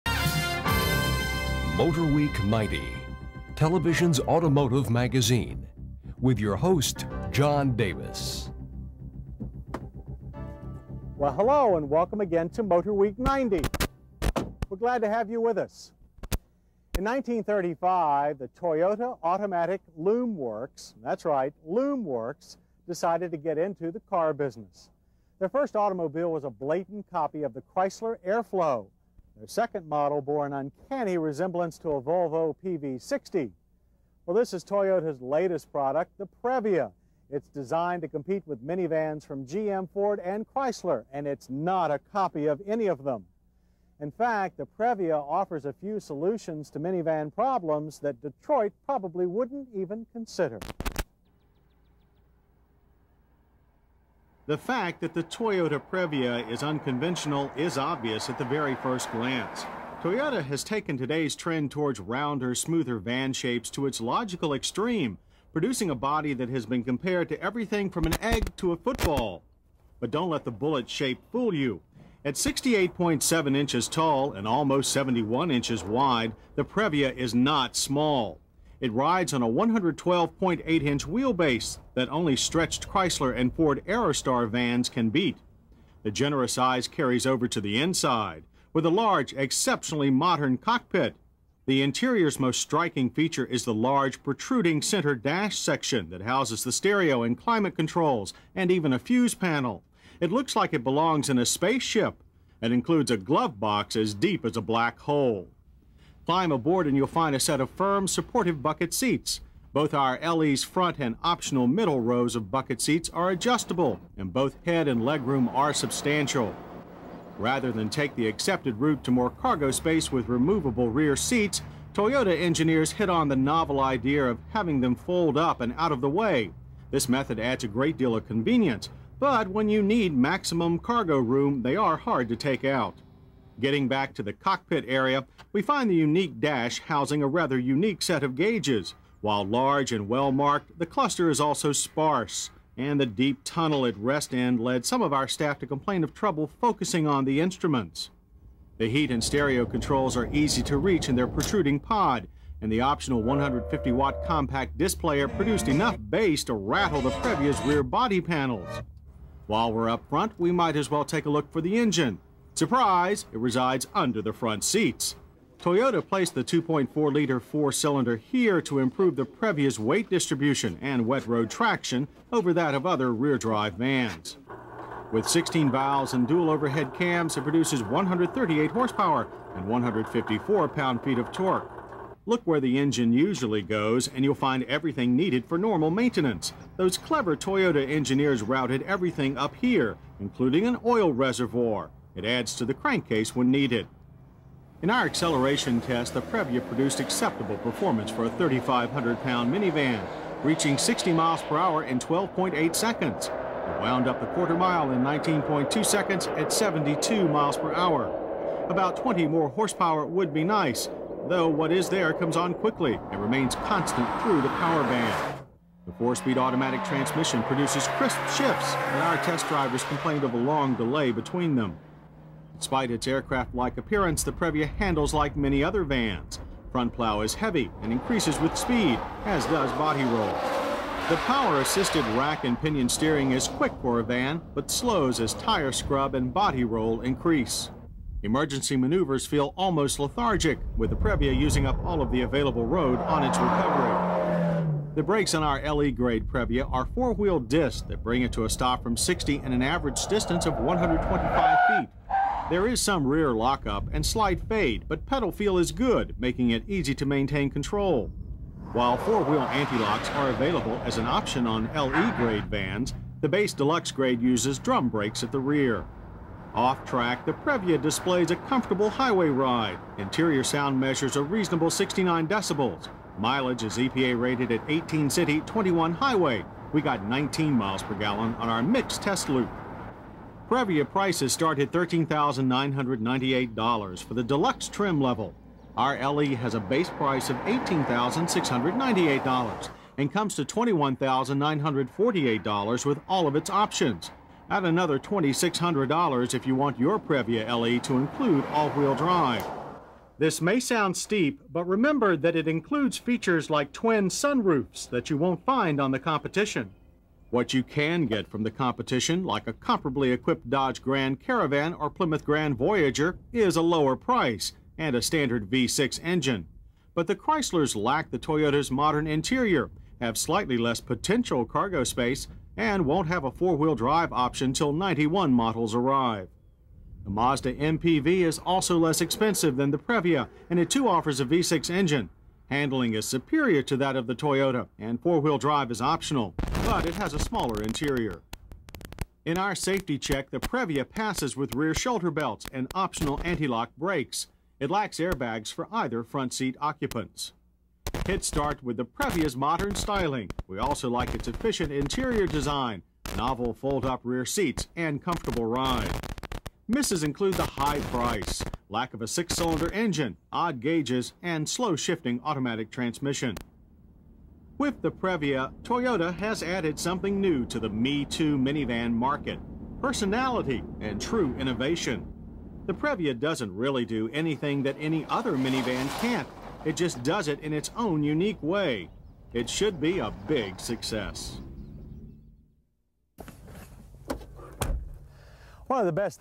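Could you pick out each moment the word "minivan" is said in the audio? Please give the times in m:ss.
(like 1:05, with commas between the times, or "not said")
0:38, 0:46, 3:19, 6:08, 6:15.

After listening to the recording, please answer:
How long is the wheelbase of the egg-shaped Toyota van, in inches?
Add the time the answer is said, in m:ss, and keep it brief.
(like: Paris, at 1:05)
112.8 inches, at 1:19.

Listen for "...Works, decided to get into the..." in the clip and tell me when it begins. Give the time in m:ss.
0:22.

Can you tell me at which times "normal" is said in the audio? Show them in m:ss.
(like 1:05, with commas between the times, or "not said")
3:05.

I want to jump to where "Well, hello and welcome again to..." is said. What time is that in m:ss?
0:11.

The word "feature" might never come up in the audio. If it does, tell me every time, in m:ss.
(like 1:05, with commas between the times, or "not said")
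1:33, 5:02.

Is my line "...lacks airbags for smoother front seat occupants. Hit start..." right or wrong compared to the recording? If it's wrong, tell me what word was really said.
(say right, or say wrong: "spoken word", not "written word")
wrong: "either", not "smoother".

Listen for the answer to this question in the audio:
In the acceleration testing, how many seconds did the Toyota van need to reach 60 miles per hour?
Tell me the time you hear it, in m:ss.
3:21.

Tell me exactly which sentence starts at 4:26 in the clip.
Off track, the Previa displays a comfortable highway ride.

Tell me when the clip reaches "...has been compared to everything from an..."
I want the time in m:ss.
1:06.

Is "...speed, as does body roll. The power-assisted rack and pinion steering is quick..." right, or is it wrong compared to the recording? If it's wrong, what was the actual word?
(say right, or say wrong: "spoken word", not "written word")
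right.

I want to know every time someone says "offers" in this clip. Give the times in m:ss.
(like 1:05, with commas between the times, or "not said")
0:45, 5:30.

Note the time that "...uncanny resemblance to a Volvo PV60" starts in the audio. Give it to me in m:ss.
0:30.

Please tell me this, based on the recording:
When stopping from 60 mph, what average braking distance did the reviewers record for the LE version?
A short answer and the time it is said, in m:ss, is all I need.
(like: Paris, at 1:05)
125 feet, at 4:10.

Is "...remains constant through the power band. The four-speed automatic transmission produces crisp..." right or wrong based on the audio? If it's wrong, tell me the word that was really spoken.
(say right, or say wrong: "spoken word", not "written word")
right.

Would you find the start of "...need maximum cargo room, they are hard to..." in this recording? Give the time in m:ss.
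2:09.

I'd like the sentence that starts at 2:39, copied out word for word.
While we're up front, we might as well take a look for the engine.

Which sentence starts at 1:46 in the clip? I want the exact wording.
Climb aboard and you'll find a set of firm, supportive bucket seats.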